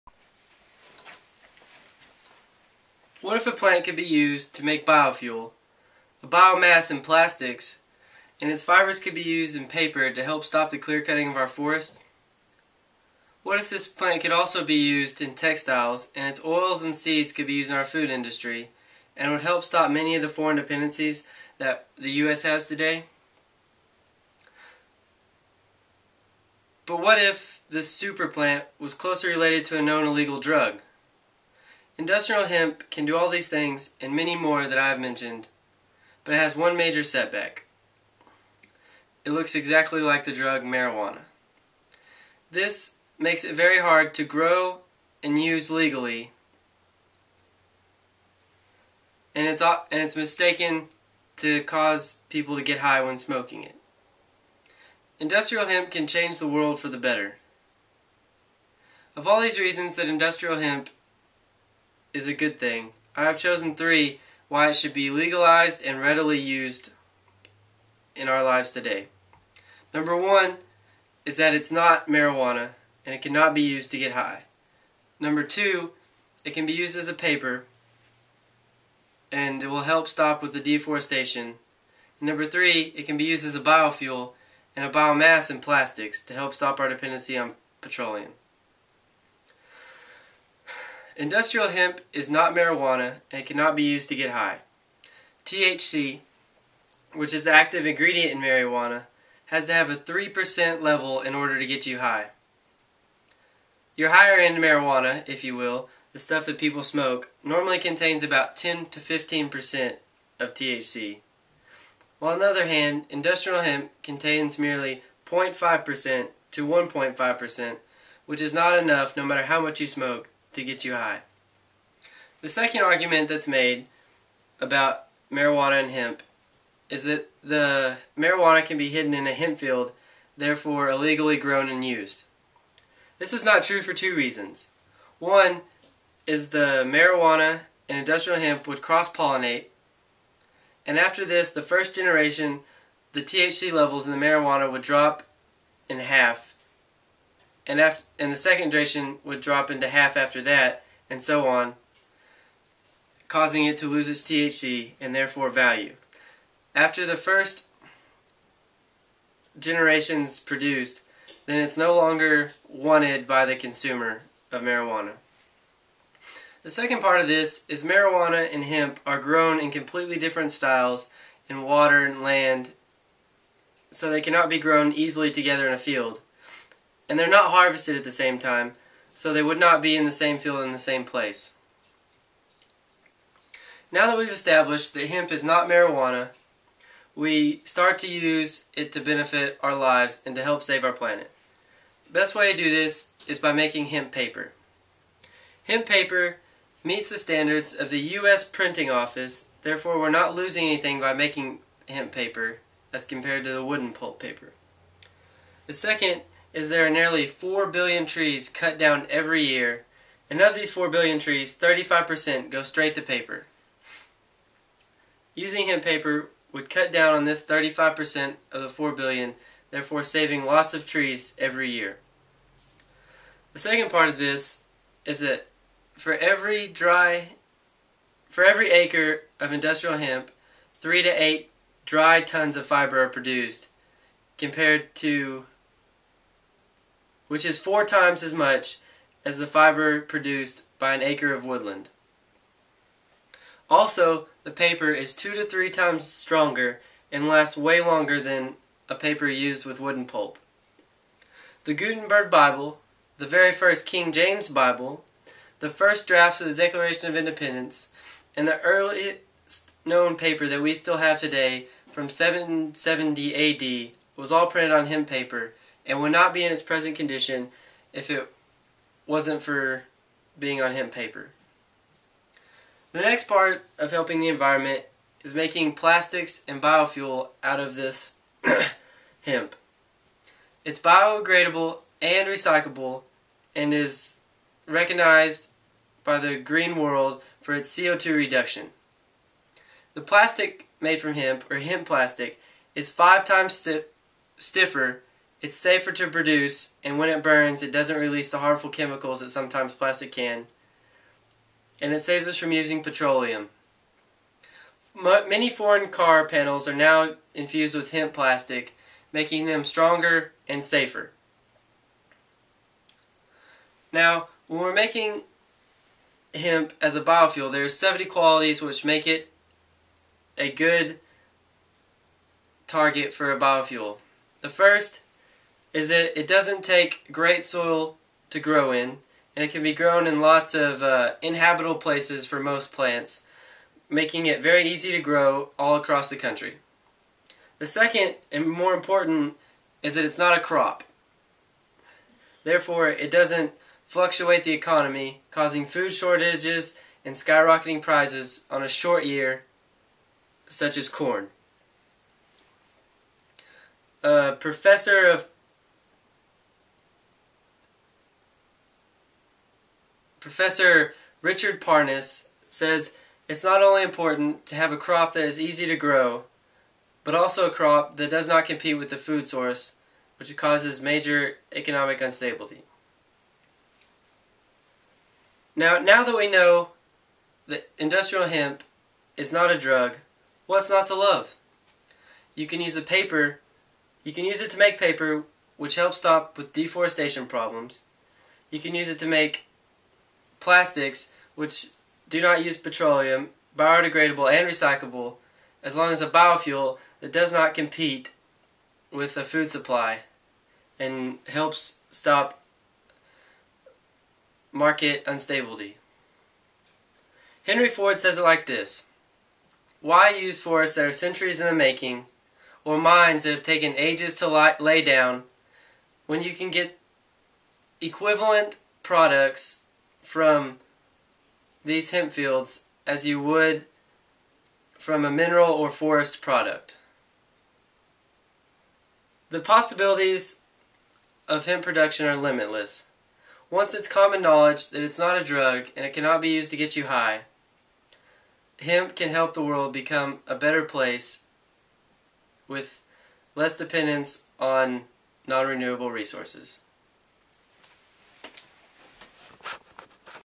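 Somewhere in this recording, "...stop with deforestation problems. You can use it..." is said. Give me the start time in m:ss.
6:25.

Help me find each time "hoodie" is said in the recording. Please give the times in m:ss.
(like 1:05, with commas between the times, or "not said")
not said.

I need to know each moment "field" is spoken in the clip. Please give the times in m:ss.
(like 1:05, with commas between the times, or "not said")
2:09, 2:55, 3:00, 7:02.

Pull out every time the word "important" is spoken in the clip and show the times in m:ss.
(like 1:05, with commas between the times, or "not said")
5:38, 6:03.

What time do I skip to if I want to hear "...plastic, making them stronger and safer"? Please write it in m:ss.
5:08.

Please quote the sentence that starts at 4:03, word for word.
Also, the paper is two to three times stronger and lasts way longer than a paper used with wooden pulp.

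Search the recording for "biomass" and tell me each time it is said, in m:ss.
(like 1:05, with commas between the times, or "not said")
0:06, 1:24.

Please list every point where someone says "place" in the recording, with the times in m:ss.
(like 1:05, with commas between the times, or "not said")
3:01, 5:31, 7:20.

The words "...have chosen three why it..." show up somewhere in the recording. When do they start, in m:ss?
1:03.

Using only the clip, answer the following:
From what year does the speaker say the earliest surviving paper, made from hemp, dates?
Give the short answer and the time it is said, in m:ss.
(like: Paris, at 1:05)
770 AD, at 4:22.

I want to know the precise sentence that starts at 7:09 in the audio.
The possibilities of hemp production are limitless.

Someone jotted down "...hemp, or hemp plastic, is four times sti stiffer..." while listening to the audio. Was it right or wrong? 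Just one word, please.
wrong.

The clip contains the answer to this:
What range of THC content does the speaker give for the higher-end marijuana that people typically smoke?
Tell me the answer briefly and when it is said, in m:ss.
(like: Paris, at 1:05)
10 to 15%, at 1:48.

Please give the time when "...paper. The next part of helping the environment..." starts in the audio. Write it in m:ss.
4:30.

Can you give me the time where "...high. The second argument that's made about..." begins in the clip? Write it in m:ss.
2:00.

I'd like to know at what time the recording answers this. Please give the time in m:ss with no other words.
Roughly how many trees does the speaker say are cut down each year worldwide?
3:26.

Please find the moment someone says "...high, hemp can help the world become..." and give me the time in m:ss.
7:16.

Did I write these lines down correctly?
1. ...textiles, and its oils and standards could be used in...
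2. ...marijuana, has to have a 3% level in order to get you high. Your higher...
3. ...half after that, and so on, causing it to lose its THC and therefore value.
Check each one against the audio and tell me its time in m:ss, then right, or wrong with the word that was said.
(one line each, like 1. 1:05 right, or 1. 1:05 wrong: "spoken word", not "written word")
1. 0:15 wrong: "seeds", not "standards"
2. 1:38 right
3. 2:29 right.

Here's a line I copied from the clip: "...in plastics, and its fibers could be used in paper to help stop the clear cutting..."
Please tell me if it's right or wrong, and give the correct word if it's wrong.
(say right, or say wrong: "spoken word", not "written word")
right.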